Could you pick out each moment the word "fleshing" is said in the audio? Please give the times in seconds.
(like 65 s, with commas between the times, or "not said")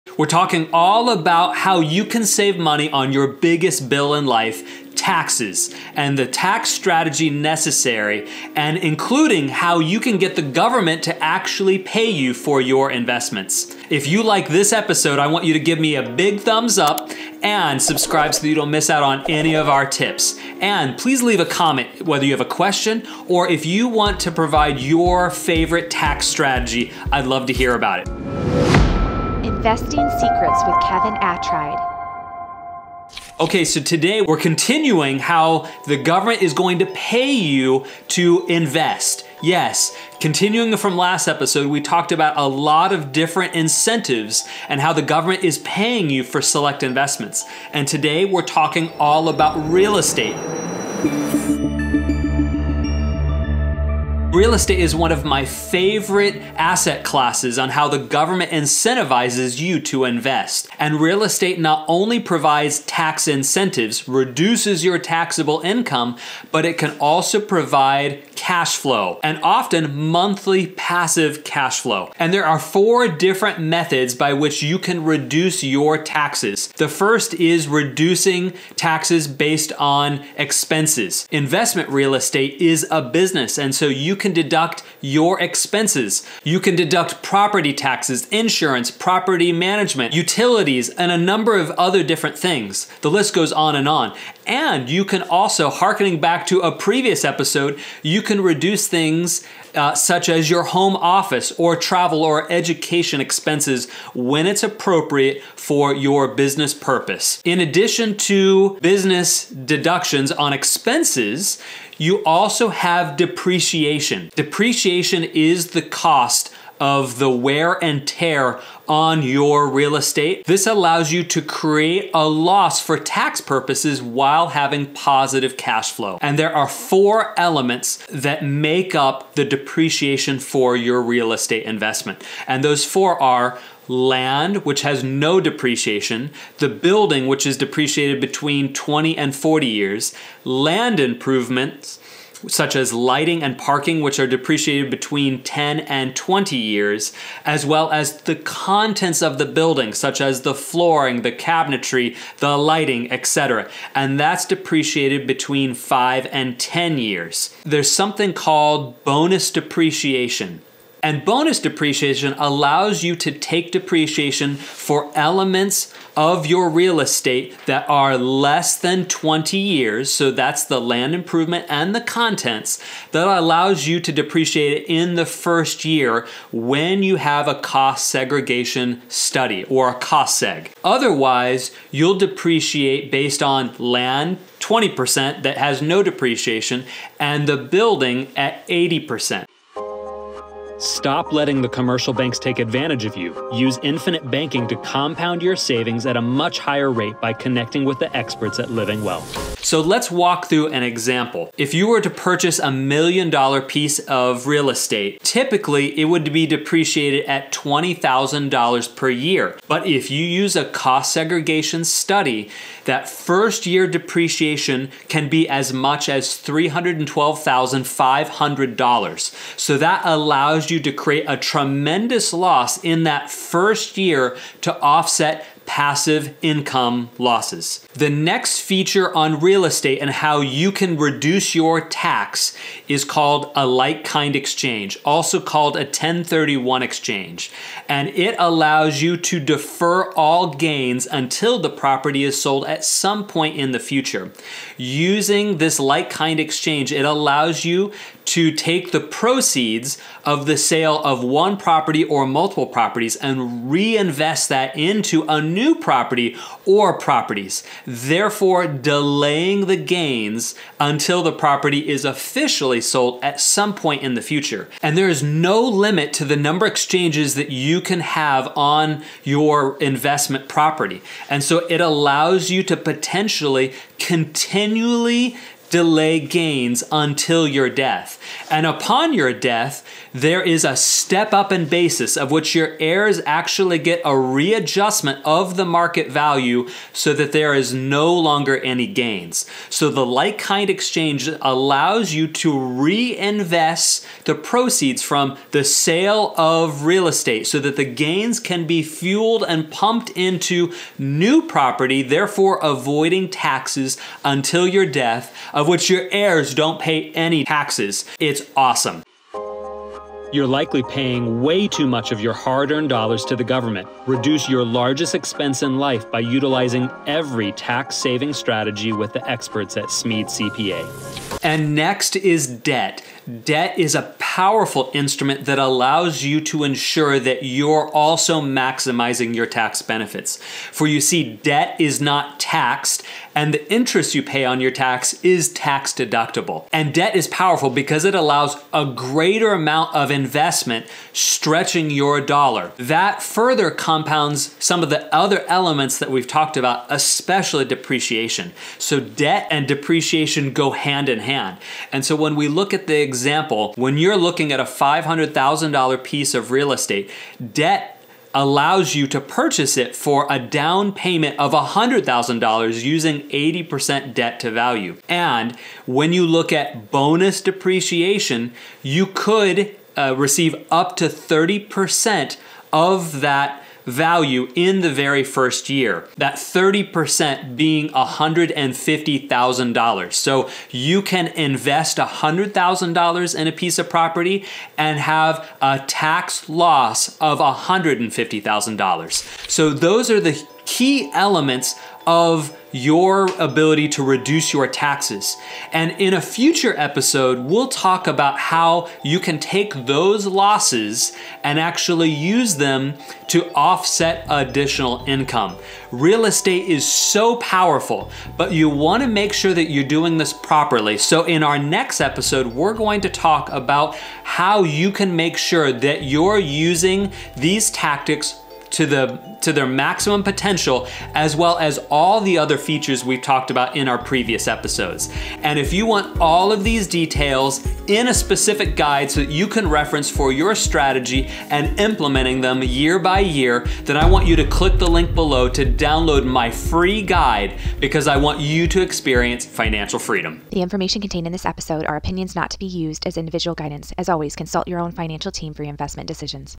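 not said.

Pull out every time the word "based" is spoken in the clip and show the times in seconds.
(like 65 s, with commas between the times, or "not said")
79 s, 183 s.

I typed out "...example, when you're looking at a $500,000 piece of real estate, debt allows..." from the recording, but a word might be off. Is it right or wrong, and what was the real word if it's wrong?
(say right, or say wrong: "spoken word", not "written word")
right.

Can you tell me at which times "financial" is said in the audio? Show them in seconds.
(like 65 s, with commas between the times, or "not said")
439 s, 444 s.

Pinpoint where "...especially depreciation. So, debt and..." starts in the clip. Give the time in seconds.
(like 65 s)
346 s.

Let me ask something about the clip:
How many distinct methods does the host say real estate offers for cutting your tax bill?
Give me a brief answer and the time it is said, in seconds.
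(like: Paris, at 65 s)
4, at 72 s.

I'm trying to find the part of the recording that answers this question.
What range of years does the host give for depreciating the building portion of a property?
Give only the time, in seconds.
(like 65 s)
138 s.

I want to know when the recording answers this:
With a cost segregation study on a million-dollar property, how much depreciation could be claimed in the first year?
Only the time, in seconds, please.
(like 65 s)
216 s.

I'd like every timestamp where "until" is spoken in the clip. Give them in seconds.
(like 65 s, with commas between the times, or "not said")
241 s, 260 s, 276 s, 304 s.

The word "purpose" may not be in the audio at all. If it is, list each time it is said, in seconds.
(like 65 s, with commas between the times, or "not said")
106 s, 123 s.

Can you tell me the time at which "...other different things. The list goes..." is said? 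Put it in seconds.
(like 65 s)
91 s.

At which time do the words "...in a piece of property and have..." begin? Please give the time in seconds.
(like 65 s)
383 s.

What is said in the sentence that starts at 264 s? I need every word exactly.
And there is no limit to the number of exchanges that you can have on your investment property.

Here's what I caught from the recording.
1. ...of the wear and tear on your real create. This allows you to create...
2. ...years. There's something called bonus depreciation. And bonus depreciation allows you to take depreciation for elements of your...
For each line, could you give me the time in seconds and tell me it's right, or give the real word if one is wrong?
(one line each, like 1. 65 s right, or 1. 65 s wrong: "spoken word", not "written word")
1. 116 s wrong: "estate", not "create"
2. 156 s right.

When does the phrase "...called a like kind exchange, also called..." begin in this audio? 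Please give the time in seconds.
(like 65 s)
233 s.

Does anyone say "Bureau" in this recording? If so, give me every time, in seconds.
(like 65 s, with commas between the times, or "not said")
not said.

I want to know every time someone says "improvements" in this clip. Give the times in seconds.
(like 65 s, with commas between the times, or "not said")
140 s, 171 s.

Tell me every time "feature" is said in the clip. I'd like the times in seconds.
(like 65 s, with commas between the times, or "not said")
228 s, 422 s.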